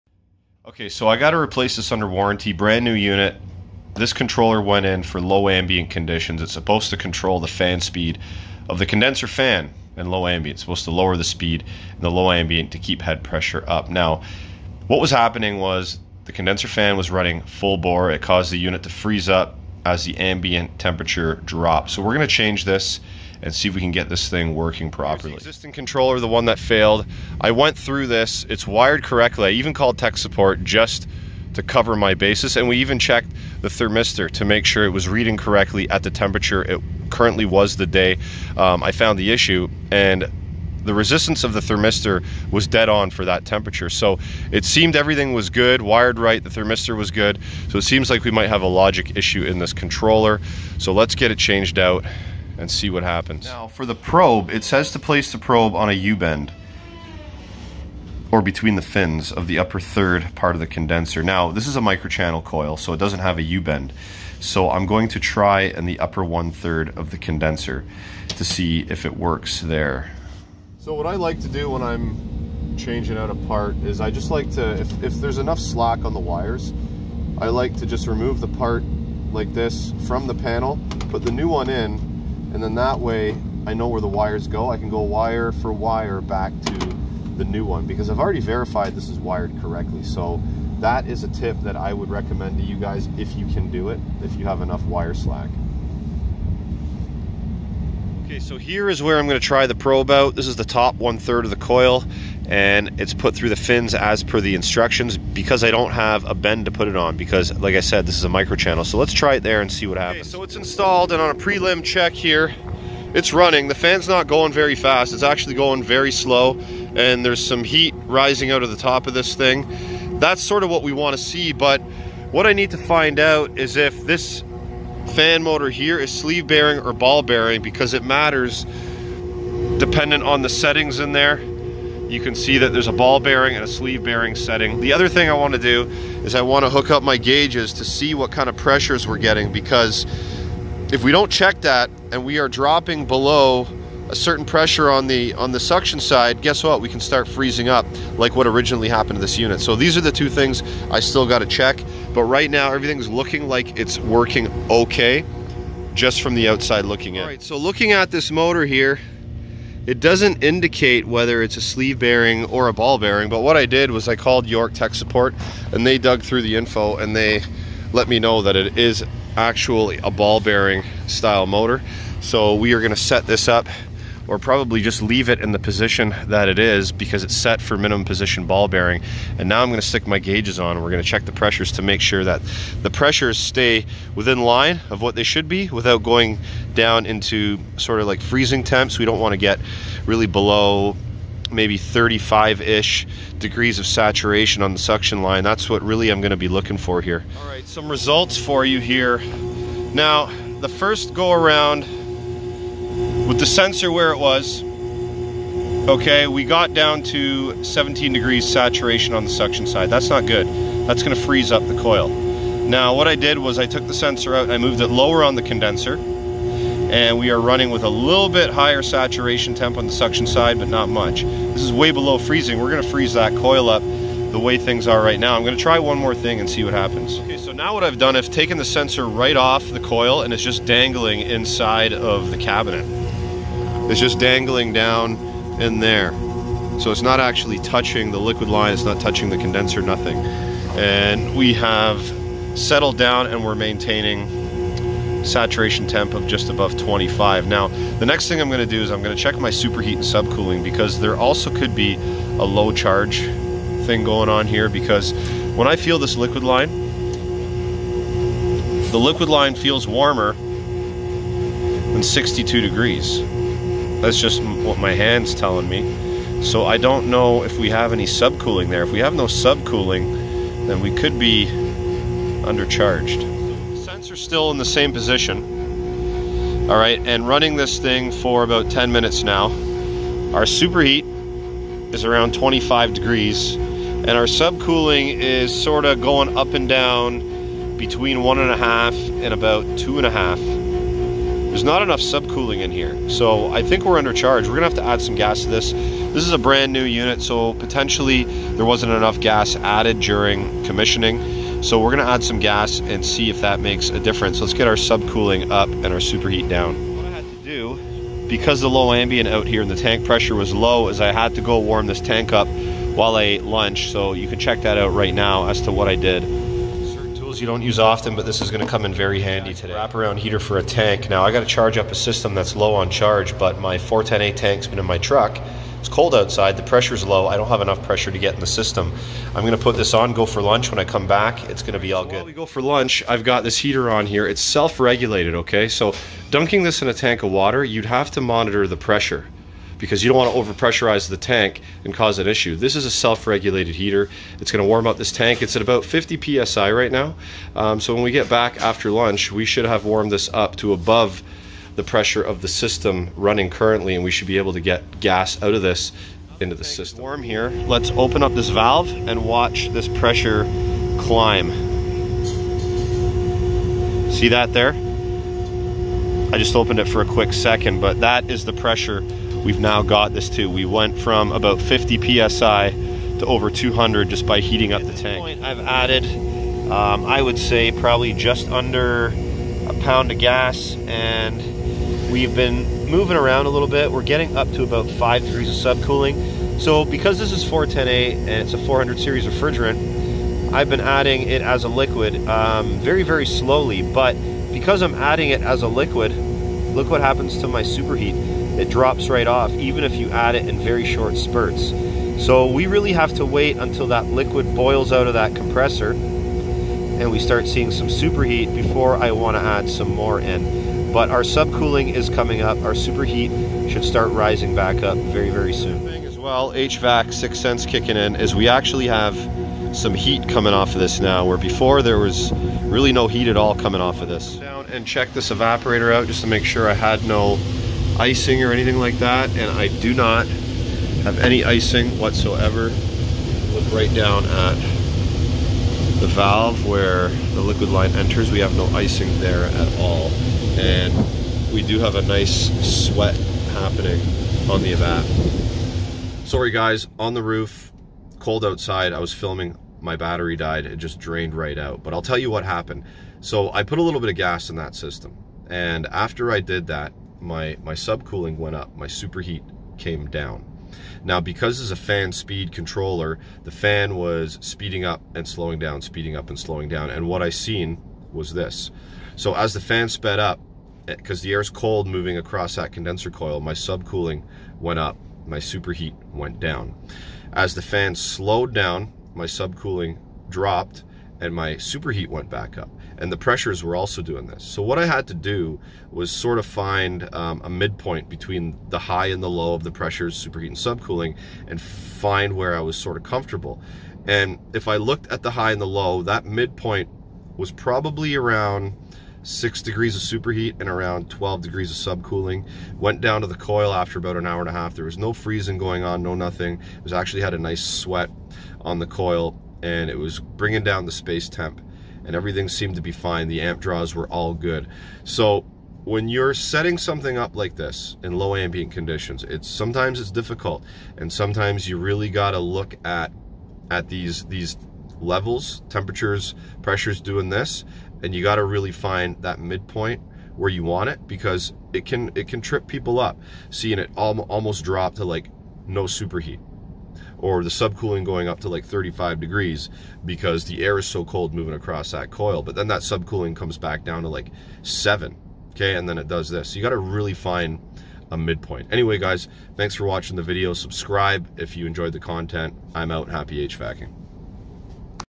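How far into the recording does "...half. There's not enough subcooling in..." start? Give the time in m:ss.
4:50.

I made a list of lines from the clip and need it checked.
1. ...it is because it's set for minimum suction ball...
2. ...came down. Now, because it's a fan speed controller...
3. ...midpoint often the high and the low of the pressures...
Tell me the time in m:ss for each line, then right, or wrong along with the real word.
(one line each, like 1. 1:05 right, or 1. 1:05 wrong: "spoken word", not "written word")
1. 2:56 wrong: "position", not "suction"
2. 7:39 right
3. 8:07 wrong: "between", not "often".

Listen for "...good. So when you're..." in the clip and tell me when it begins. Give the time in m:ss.
8:34.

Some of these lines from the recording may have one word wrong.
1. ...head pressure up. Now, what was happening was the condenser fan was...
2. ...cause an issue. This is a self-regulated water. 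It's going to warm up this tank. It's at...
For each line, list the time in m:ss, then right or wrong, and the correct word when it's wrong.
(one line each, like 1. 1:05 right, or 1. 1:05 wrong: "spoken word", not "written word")
1. 0:13 right
2. 5:41 wrong: "heater", not "water".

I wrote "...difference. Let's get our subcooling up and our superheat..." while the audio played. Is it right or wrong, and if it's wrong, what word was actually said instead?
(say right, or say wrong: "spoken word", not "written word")
right.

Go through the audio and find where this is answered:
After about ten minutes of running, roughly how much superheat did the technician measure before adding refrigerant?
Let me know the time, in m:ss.
4:42.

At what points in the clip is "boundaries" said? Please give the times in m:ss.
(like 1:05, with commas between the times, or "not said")
not said.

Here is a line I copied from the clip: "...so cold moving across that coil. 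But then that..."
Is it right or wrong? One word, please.
right.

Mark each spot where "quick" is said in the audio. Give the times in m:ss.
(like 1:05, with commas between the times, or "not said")
6:07.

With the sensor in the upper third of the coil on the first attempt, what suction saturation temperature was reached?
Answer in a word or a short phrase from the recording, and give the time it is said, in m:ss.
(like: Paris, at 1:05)
17 degrees, at 3:27.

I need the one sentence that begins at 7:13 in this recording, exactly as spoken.
Look right down at the valve where the liquid line enters.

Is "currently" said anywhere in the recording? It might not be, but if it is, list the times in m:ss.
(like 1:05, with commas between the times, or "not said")
0:37, 5:53.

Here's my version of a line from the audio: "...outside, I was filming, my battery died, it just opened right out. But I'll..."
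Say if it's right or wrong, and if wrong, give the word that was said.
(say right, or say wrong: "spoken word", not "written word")
wrong: "drained", not "opened".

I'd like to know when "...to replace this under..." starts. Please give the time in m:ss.
0:01.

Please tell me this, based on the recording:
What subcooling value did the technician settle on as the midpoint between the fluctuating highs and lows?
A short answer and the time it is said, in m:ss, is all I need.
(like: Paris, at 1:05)
12 degrees, at 8:21.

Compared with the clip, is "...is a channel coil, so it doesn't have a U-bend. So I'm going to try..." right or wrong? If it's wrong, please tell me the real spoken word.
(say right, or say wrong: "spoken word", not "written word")
wrong: "microchannel", not "channel".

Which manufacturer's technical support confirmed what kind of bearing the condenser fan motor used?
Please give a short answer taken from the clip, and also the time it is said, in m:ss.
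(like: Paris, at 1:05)
York, at 2:44.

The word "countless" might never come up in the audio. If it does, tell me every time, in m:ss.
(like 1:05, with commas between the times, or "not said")
not said.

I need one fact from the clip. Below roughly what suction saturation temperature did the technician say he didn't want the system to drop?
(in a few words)
35 degrees.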